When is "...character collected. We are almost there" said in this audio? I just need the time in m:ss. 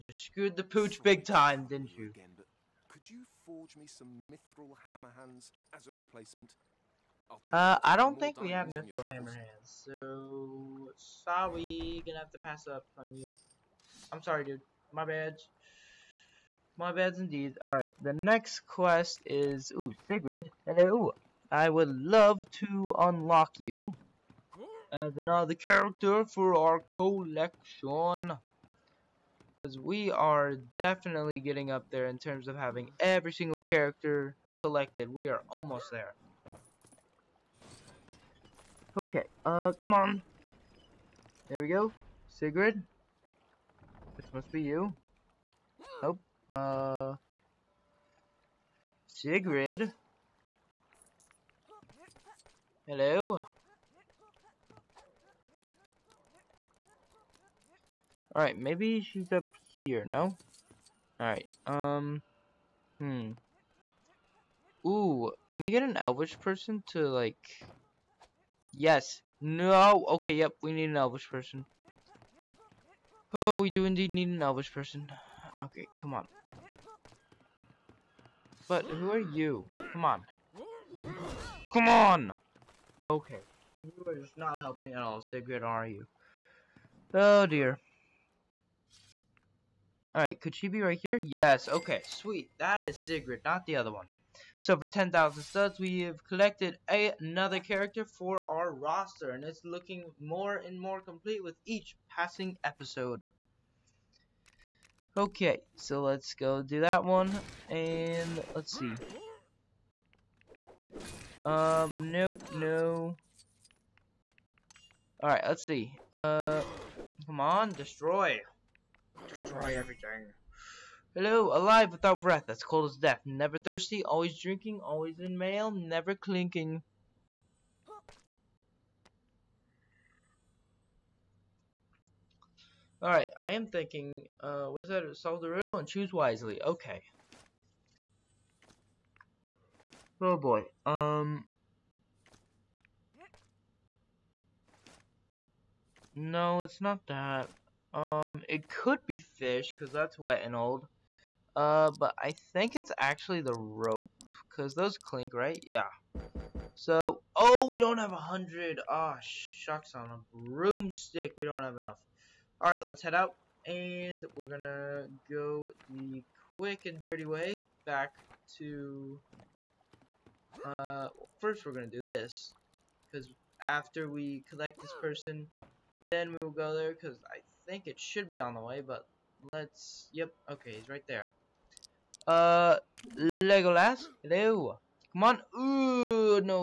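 0:33.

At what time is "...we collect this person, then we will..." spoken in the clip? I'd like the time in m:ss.
2:54.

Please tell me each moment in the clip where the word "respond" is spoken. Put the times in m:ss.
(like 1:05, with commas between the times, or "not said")
not said.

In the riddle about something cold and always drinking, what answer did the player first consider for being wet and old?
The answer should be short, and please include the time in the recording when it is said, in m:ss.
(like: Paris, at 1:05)
fish, at 2:29.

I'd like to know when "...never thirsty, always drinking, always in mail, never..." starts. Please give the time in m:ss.
2:03.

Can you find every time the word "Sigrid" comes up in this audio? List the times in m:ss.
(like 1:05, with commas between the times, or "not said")
0:20, 0:42, 0:49, 1:25, 1:32.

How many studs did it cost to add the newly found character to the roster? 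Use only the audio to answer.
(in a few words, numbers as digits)
10,000.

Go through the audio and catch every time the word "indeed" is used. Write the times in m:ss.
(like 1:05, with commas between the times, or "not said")
0:17, 1:13.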